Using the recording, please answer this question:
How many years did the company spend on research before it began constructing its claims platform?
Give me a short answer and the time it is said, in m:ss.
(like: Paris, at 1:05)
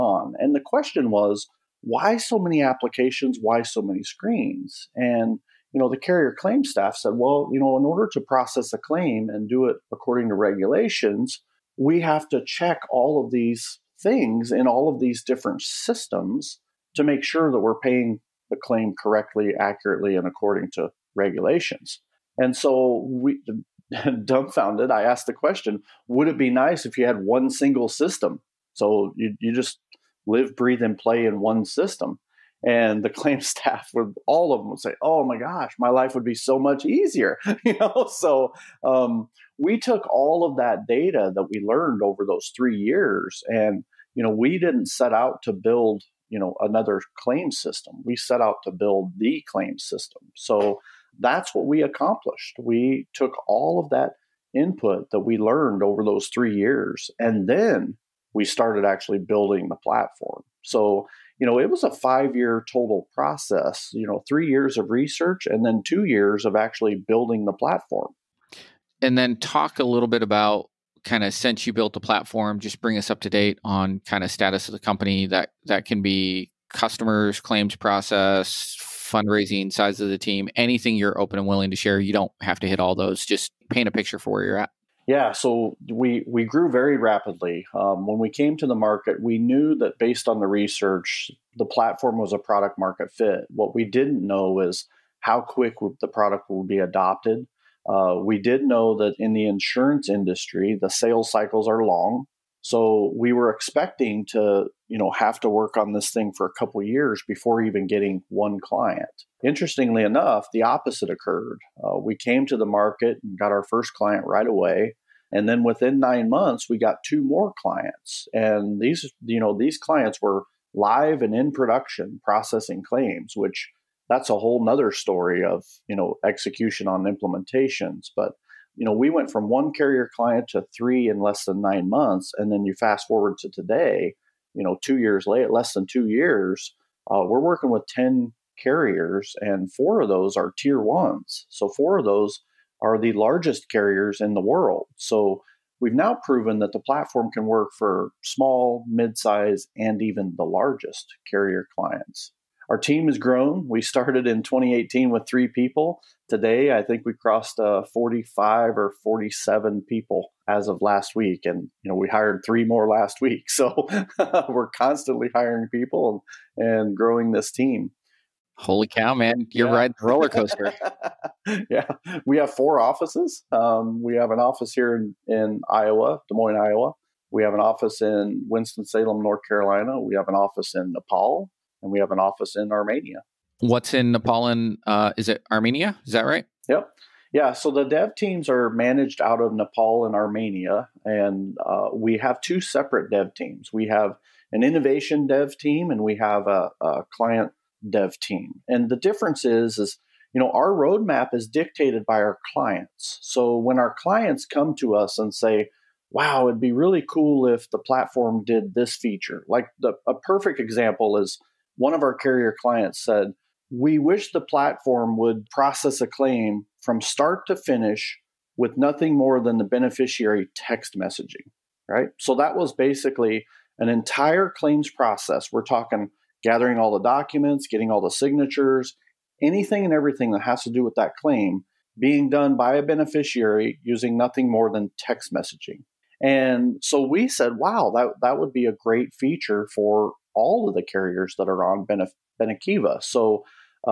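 3, at 1:04.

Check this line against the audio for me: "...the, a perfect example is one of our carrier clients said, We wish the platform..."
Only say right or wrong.
right.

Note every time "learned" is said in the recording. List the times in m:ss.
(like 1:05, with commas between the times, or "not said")
0:41, 0:55.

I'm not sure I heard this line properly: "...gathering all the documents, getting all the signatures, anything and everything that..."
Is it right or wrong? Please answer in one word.
right.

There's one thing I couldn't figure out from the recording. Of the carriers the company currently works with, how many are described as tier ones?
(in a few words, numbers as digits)
4.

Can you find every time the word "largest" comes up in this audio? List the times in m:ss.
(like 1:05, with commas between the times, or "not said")
2:23, 2:30.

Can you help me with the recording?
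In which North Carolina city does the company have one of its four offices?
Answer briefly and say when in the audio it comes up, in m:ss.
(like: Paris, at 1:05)
Winston Salem, at 2:58.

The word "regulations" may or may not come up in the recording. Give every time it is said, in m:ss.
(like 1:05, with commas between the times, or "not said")
0:10, 0:21.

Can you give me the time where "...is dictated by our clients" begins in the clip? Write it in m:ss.
3:21.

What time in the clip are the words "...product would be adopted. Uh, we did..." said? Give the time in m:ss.
1:36.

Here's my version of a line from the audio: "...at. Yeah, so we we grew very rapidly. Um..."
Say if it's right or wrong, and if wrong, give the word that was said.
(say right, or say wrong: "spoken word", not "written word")
right.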